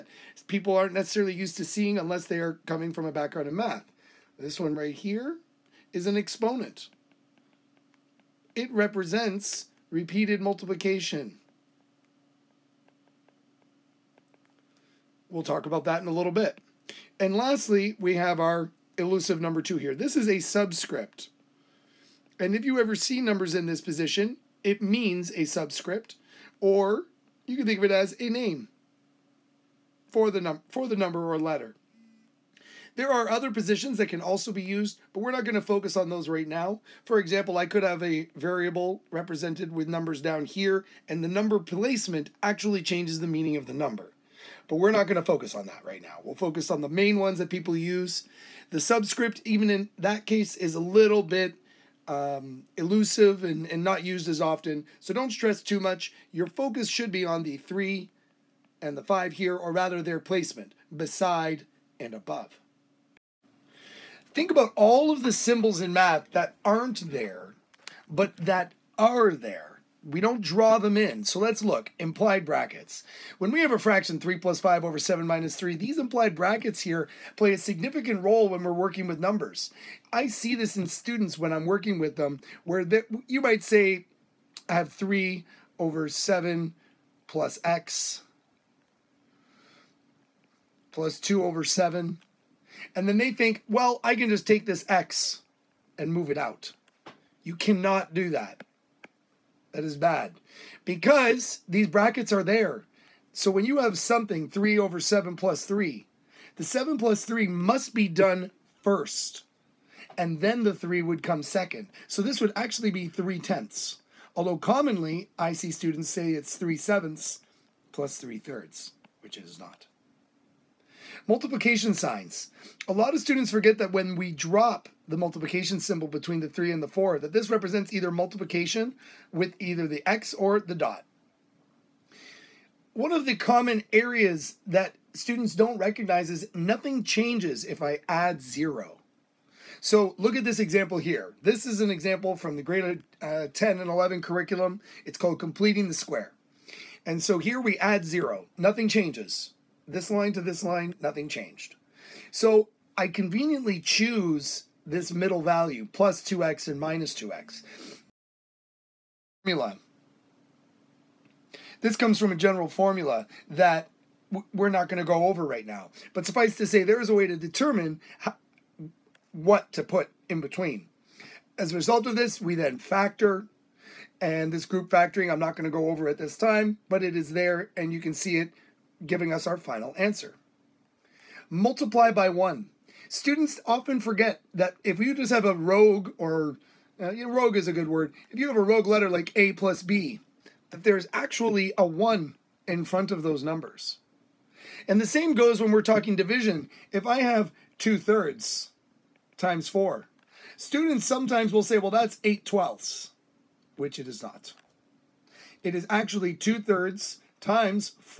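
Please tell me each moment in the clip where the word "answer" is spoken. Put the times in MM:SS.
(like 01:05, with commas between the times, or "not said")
02:59.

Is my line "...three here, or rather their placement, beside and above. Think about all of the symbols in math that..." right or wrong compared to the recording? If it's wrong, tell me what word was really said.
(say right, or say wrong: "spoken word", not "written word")
wrong: "five", not "three".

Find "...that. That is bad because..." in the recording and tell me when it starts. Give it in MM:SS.
01:38.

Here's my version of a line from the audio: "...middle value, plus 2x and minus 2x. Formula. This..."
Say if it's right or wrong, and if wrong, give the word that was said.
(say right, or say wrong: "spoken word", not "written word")
right.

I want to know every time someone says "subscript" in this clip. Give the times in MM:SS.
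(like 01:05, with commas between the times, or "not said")
00:20, 00:25, 00:48.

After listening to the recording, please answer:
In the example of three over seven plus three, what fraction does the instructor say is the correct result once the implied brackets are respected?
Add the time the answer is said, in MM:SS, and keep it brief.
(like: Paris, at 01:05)
3 tenths, at 01:53.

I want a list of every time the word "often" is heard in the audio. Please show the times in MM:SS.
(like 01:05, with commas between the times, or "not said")
00:54, 03:03.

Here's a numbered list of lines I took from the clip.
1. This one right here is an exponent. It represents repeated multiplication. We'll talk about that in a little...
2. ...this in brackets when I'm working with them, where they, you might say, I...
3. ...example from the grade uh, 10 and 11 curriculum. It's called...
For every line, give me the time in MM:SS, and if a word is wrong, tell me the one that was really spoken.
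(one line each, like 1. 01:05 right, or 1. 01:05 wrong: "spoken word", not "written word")
1. 00:04 right
2. 01:20 wrong: "students", not "brackets"
3. 02:21 right.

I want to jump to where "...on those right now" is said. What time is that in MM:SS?
00:35.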